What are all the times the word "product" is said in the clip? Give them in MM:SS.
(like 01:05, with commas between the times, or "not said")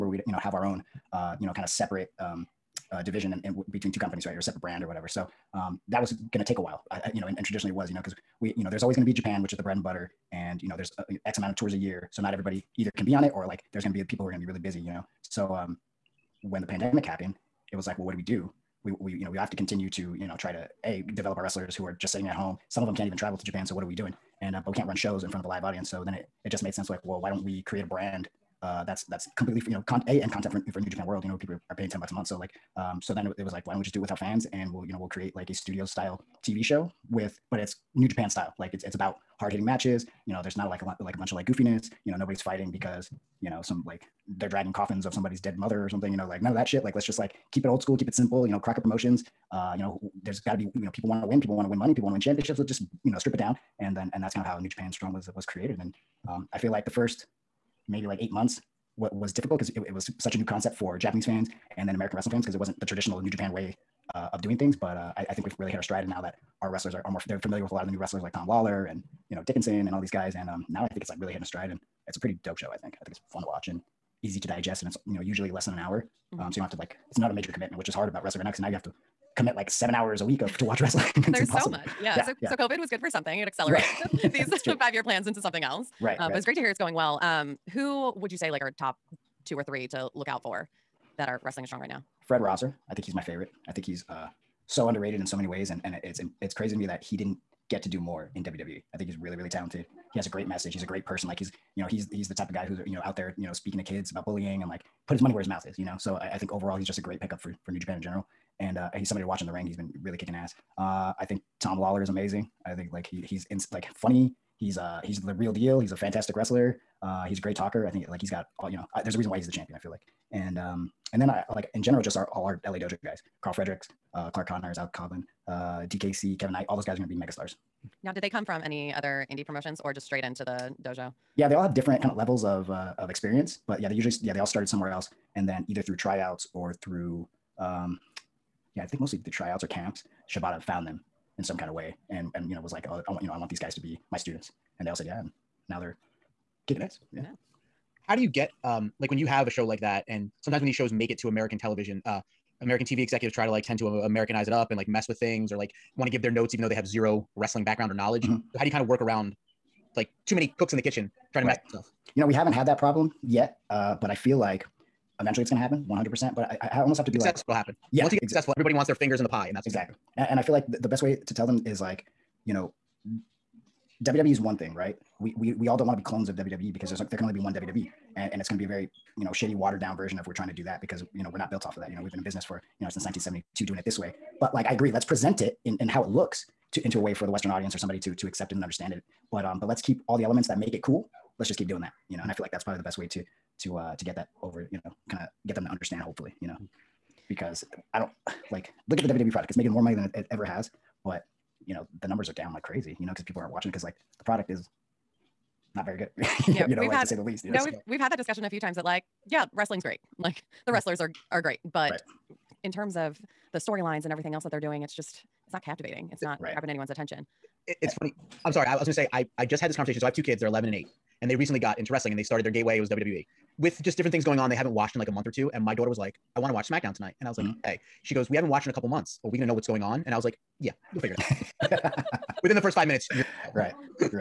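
03:19, 03:24.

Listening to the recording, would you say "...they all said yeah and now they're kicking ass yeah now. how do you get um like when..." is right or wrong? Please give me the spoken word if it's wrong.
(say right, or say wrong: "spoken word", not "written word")
right.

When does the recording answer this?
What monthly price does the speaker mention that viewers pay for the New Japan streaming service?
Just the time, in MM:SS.
00:31.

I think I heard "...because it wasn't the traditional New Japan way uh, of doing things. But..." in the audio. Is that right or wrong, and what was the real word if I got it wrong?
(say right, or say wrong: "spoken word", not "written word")
right.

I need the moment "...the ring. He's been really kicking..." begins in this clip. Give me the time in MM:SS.
01:49.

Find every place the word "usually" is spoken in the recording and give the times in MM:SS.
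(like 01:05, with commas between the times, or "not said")
01:15, 02:13.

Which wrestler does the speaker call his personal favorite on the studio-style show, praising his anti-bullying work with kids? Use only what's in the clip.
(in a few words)
Fred Rosser.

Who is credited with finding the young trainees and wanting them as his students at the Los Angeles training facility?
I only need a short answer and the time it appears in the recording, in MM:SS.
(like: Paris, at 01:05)
Shibata, at 02:20.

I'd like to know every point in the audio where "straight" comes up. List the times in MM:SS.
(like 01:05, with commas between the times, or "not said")
02:10.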